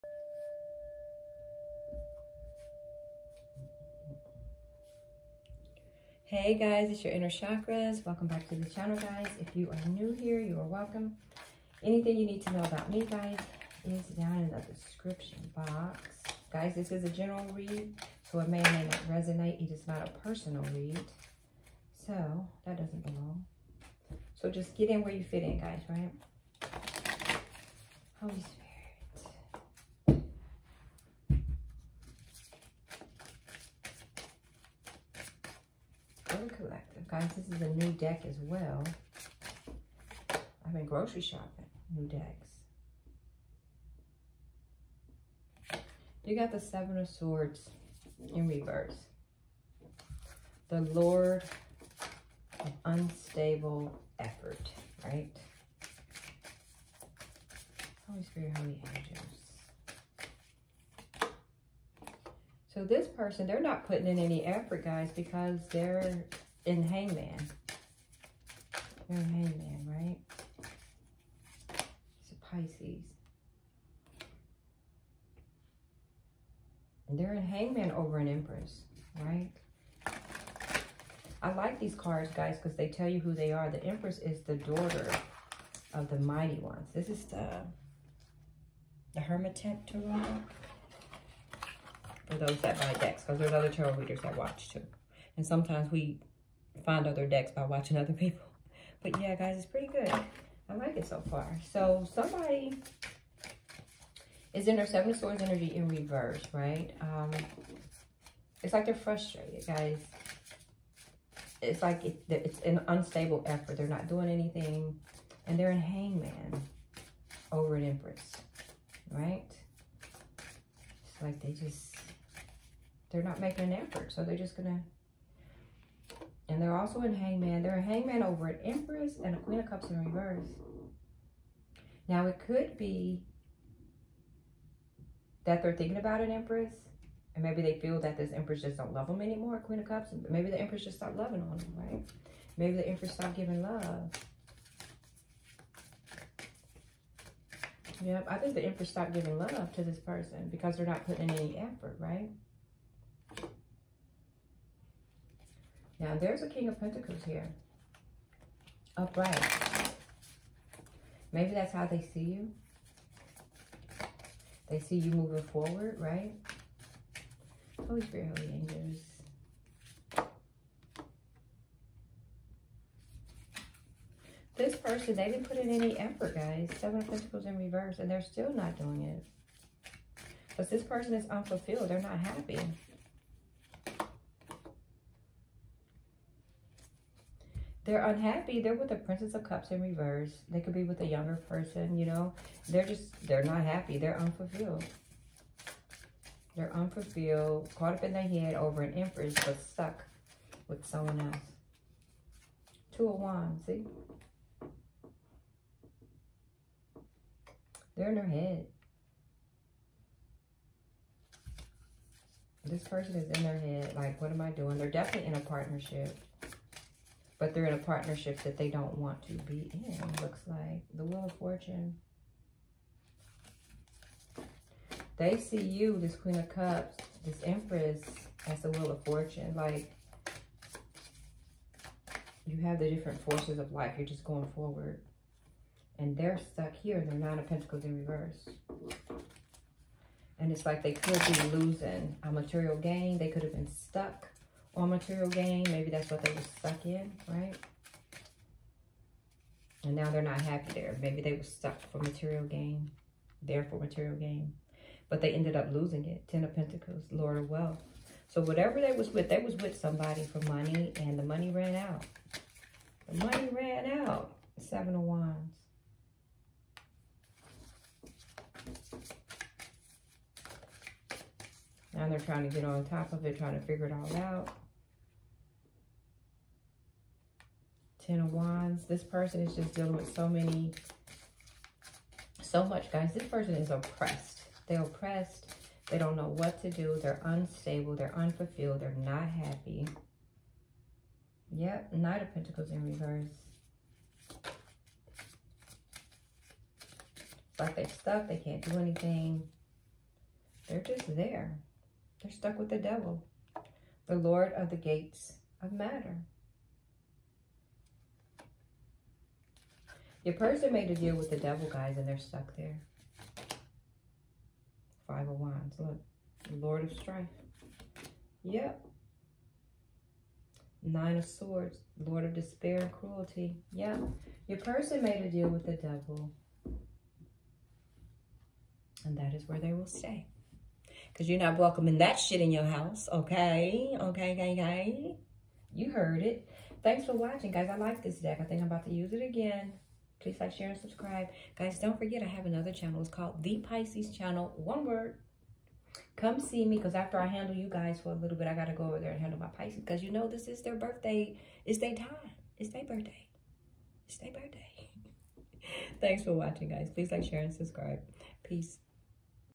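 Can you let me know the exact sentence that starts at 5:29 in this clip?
And that is where they will stay.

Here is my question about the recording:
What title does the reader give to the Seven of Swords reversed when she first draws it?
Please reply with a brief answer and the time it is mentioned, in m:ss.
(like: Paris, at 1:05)
Lord of Unstable Effort, at 0:50.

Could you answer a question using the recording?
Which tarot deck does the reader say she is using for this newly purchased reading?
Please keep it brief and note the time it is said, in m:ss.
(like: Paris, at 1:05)
The Hermit Tarot, at 1:29.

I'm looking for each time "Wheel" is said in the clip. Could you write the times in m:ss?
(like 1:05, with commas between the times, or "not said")
3:41, 3:48.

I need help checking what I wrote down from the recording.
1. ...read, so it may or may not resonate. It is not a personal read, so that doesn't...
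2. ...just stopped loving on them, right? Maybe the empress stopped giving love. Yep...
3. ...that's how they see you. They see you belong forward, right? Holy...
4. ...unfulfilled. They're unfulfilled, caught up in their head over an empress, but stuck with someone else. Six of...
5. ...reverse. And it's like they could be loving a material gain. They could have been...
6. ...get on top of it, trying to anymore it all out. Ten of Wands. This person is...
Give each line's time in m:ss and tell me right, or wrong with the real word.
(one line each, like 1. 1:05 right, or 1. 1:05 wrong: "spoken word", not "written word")
1. 0:17 right
2. 2:20 right
3. 2:41 wrong: "moving", not "belong"
4. 3:14 wrong: "Two", not "Six"
5. 3:58 wrong: "losing", not "loving"
6. 4:32 wrong: "figure", not "anymore".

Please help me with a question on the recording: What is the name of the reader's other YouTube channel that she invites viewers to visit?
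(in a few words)
The Pisces Channel.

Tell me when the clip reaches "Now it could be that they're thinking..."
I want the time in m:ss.
2:12.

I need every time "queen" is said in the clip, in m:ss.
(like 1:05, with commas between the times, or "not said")
2:09, 2:19, 3:46.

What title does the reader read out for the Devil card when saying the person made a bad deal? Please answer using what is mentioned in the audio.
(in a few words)
Lord of the Gates of Matter.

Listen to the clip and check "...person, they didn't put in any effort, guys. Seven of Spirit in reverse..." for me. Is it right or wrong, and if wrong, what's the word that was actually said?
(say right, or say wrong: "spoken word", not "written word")
wrong: "Pentacles", not "Spirit".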